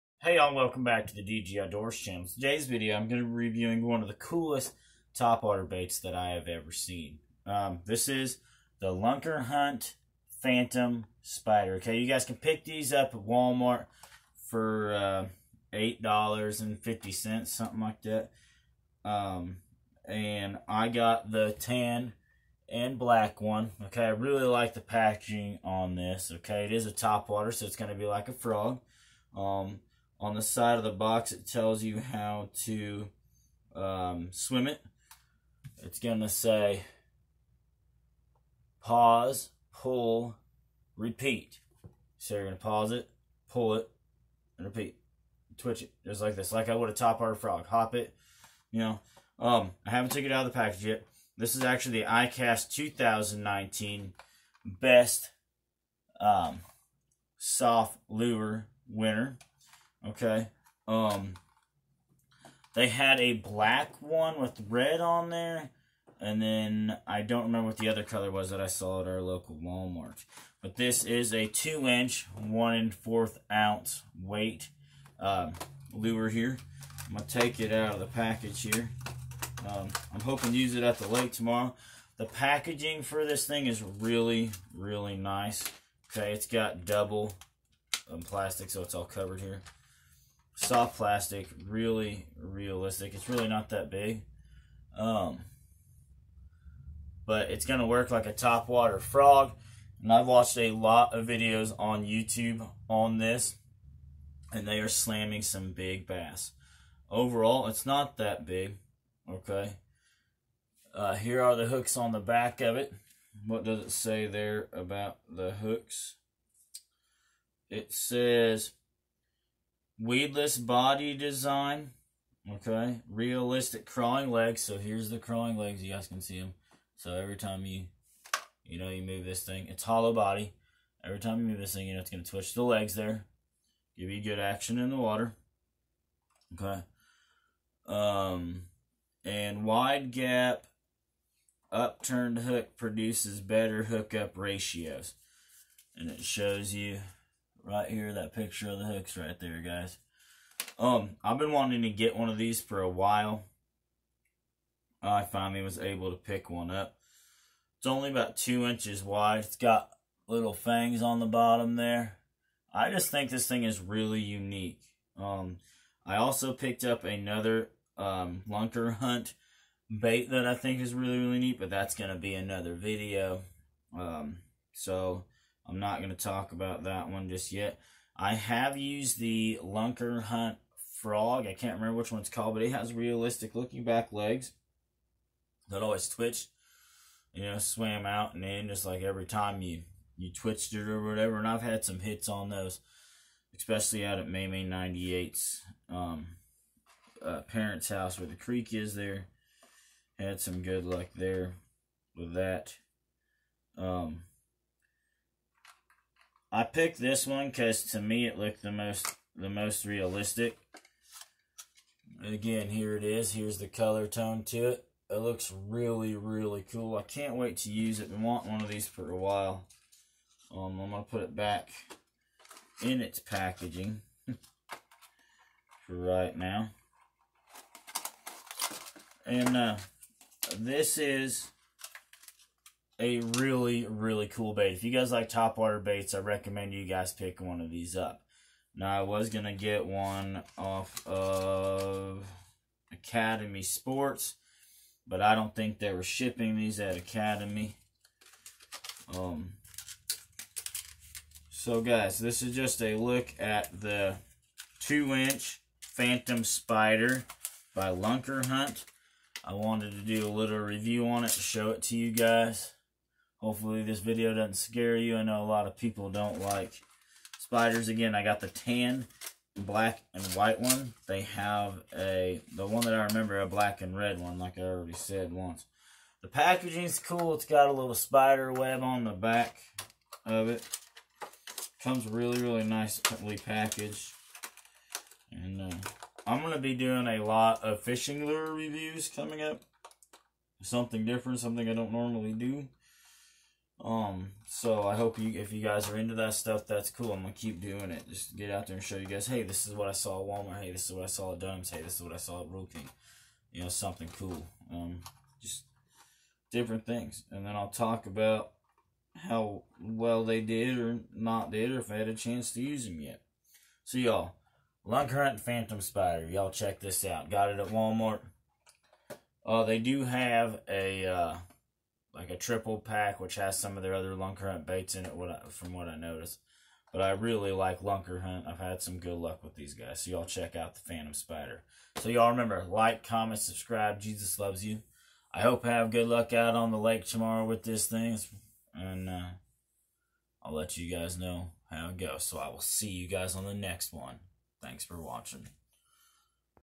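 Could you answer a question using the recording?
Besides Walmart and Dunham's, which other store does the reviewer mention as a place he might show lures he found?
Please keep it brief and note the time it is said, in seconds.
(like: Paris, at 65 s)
Rural King, at 302 s.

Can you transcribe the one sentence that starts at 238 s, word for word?
Now, I was going to get one off of Academy Sports, but I don't think they were shipping these at Academy.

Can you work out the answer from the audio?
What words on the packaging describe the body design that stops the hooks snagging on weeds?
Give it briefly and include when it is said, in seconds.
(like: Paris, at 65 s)
weedless body design, at 120 s.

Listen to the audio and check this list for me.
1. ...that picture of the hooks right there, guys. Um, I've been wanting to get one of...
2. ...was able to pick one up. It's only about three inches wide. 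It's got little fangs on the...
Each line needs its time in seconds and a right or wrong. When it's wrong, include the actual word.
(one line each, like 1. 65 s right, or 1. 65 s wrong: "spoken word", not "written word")
1. 148 s right
2. 155 s wrong: "two", not "three".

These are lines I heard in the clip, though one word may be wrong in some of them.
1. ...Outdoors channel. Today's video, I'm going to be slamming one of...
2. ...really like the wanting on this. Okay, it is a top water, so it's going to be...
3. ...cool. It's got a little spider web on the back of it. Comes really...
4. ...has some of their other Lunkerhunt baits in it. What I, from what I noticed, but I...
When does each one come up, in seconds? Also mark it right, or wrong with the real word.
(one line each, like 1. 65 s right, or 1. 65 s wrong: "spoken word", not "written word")
1. 1 s wrong: "reviewing", not "slamming"
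2. 24 s wrong: "packaging", not "wanting"
3. 276 s right
4. 323 s right.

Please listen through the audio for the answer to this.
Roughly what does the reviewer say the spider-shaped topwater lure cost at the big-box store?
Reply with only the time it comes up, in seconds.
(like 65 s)
15 s.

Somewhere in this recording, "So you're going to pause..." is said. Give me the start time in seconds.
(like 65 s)
42 s.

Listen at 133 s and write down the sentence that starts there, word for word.
Give you good action in the water.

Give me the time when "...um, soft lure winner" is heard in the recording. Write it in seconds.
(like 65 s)
56 s.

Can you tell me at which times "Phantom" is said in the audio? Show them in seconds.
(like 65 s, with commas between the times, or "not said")
10 s, 255 s, 315 s, 330 s.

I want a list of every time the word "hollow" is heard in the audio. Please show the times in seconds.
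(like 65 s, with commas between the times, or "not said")
129 s.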